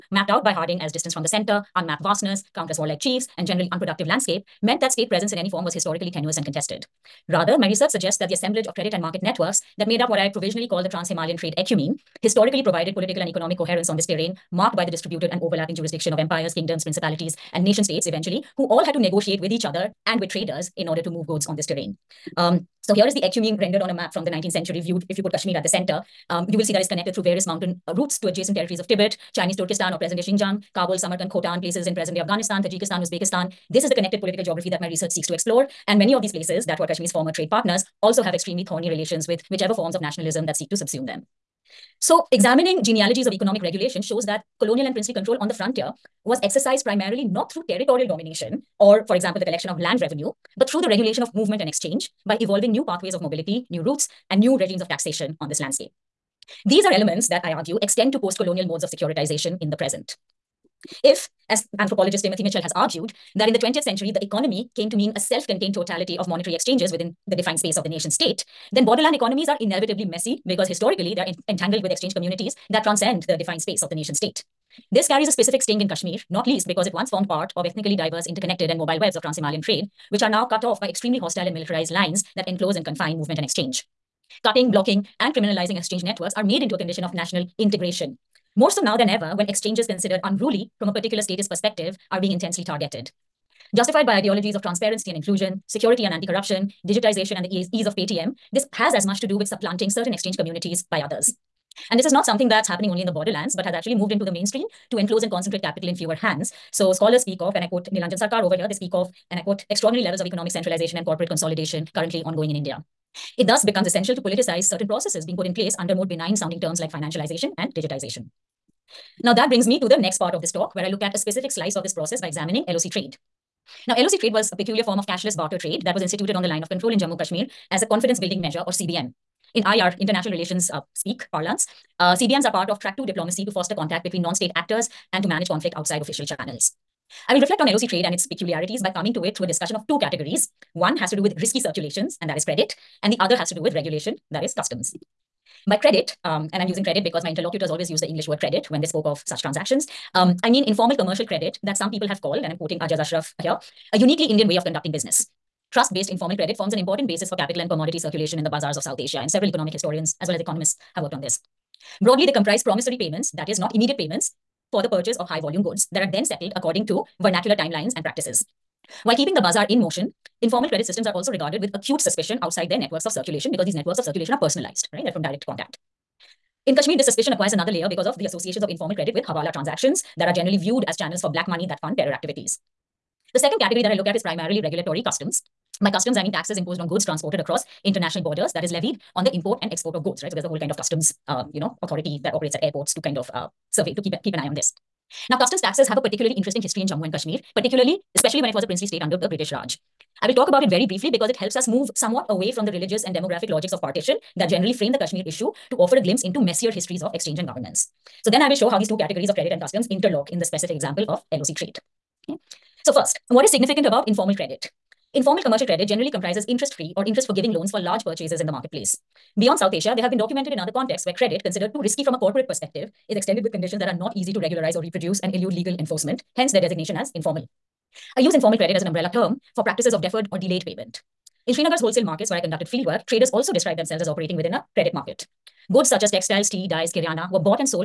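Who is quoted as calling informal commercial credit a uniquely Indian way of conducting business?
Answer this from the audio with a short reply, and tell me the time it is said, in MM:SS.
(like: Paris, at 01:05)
Ajaz Ashraf, at 02:32.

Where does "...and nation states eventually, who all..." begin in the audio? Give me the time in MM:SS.
00:17.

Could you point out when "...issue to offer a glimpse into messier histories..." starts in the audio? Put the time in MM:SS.
03:25.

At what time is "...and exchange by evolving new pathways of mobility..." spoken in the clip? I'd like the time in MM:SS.
00:51.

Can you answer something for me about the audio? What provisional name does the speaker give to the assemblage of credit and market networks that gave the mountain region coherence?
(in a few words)
Trans Himalayan Trade Ecumene.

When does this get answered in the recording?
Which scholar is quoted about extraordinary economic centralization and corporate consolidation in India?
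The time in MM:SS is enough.
01:47.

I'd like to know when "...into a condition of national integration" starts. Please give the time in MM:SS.
01:26.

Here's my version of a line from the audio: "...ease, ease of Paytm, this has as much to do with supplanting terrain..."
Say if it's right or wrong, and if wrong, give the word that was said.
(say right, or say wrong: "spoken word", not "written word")
wrong: "certain", not "terrain".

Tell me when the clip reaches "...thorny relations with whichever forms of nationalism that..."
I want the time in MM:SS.
00:38.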